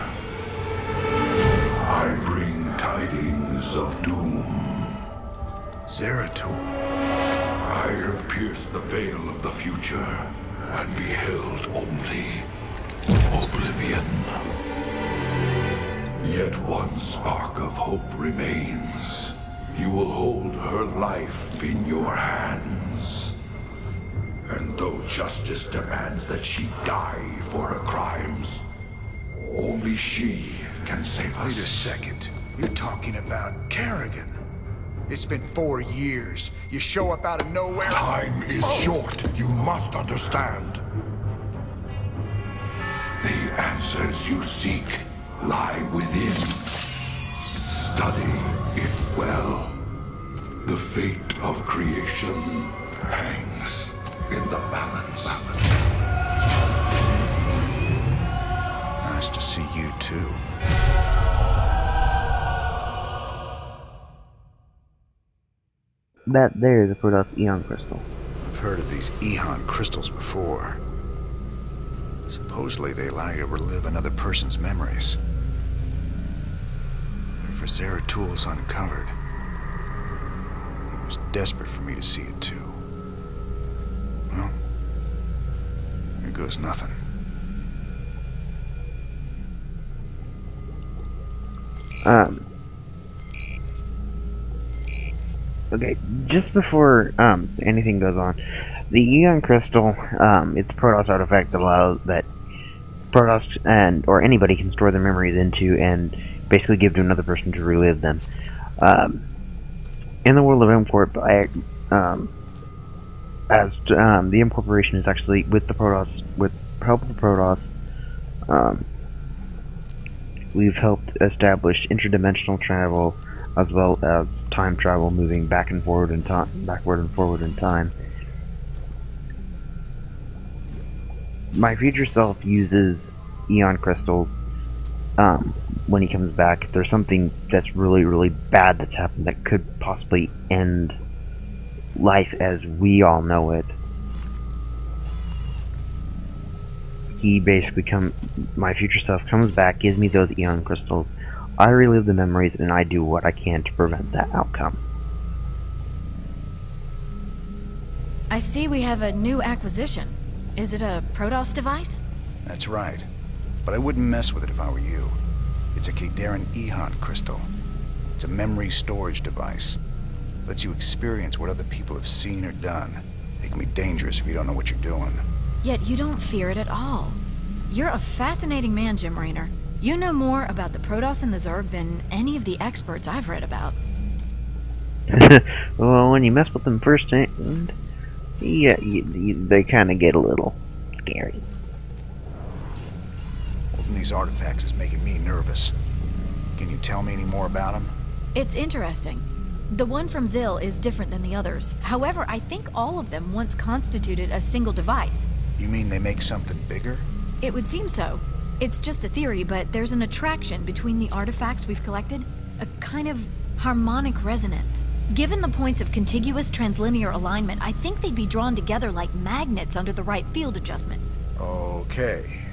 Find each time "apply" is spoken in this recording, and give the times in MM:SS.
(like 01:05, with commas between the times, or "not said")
not said.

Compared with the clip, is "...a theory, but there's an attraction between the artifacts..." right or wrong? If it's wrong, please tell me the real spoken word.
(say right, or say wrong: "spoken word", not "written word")
right.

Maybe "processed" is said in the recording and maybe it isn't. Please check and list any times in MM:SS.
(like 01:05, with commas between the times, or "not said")
not said.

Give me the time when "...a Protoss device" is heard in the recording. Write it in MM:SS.
02:40.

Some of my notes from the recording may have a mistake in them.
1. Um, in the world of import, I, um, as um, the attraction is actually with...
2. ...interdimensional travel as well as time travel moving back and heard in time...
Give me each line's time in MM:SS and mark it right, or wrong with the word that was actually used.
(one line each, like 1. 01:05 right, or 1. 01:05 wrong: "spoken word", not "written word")
1. 01:48 wrong: "incorporation", not "attraction"
2. 02:01 wrong: "forward", not "heard".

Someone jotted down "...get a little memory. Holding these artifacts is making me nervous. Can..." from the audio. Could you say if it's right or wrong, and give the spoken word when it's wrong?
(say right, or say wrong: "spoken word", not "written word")
wrong: "scary", not "memory".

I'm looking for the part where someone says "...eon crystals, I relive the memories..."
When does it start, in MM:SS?
02:30.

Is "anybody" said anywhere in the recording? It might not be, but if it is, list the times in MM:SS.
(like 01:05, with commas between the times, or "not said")
01:44.